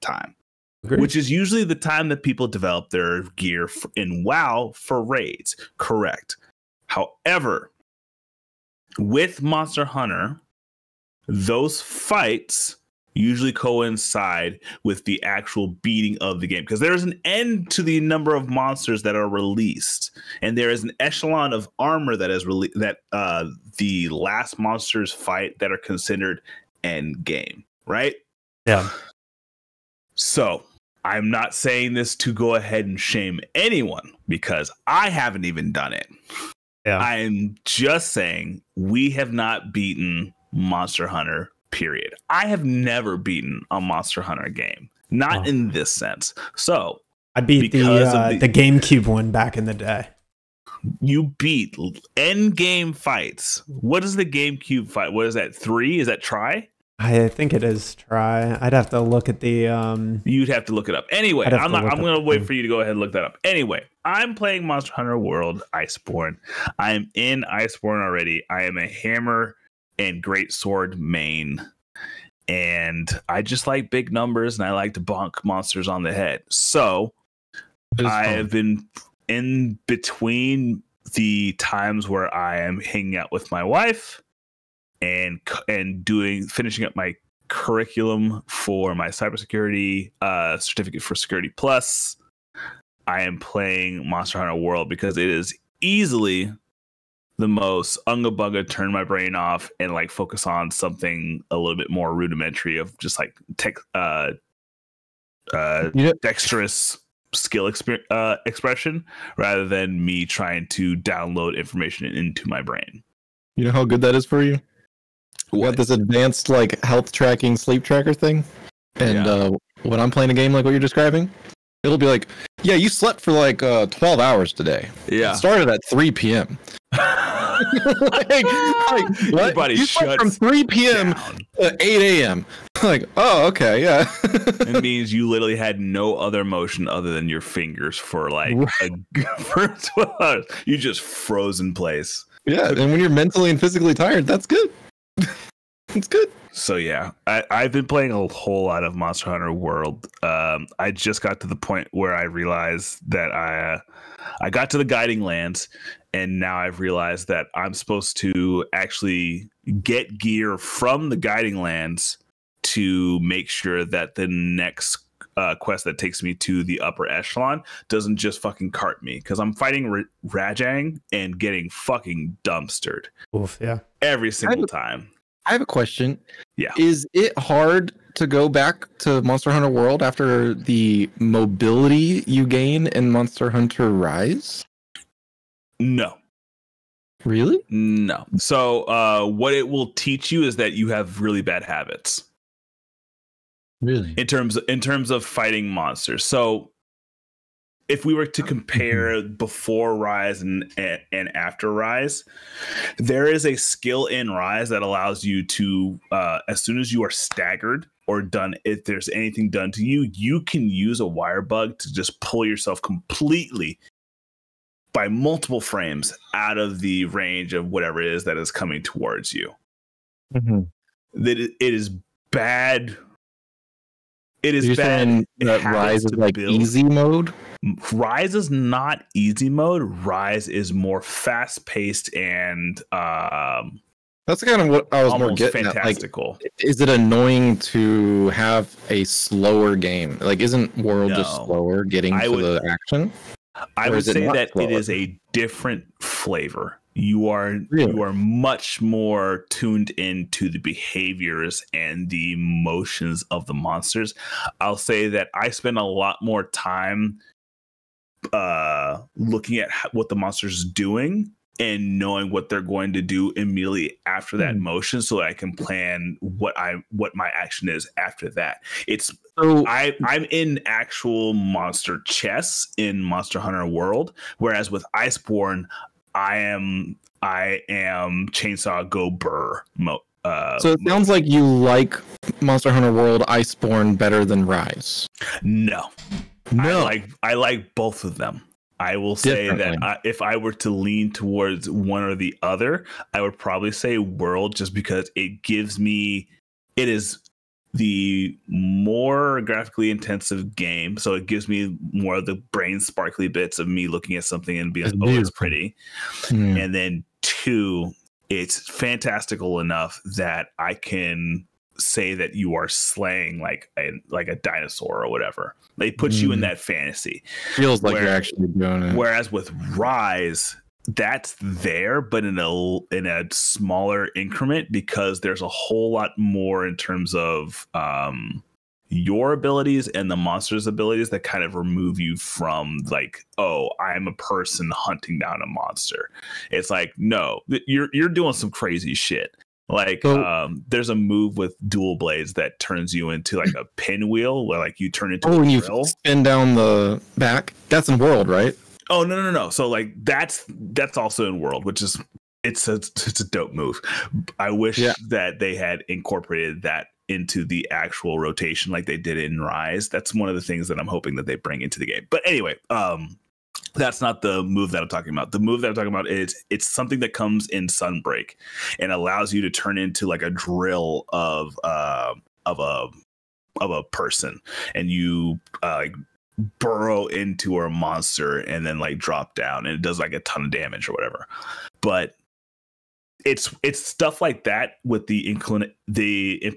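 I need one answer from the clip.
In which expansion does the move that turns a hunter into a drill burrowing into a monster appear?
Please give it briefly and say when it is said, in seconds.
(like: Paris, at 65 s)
Sunbreak, at 367 s.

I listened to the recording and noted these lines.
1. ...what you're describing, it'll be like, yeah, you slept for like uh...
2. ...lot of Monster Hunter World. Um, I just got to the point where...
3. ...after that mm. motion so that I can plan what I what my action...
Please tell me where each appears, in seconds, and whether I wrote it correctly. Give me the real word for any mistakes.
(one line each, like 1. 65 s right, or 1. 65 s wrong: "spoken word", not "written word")
1. 120 s right
2. 148 s right
3. 264 s right.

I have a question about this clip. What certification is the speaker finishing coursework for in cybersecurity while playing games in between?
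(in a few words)
Security Plus.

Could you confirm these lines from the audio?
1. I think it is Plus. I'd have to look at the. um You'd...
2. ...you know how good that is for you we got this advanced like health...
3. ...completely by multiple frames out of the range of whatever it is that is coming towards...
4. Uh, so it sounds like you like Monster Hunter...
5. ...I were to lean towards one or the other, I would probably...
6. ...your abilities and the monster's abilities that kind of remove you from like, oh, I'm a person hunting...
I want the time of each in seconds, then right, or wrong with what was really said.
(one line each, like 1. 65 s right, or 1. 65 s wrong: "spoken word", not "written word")
1. 56 s wrong: "Tri", not "Plus"
2. 113 s right
3. 212 s right
4. 280 s right
5. 290 s right
6. 328 s right.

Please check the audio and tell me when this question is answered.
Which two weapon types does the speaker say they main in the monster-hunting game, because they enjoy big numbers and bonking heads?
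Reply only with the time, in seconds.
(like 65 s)
68 s.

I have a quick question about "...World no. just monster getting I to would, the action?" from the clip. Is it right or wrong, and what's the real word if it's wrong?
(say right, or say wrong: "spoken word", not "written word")
wrong: "slower", not "monster".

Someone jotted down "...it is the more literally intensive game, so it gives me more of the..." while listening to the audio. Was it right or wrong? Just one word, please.
wrong.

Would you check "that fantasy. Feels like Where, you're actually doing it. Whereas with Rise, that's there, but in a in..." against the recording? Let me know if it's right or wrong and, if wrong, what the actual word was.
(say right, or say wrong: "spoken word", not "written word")
right.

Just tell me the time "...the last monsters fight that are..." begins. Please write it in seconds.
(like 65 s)
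23 s.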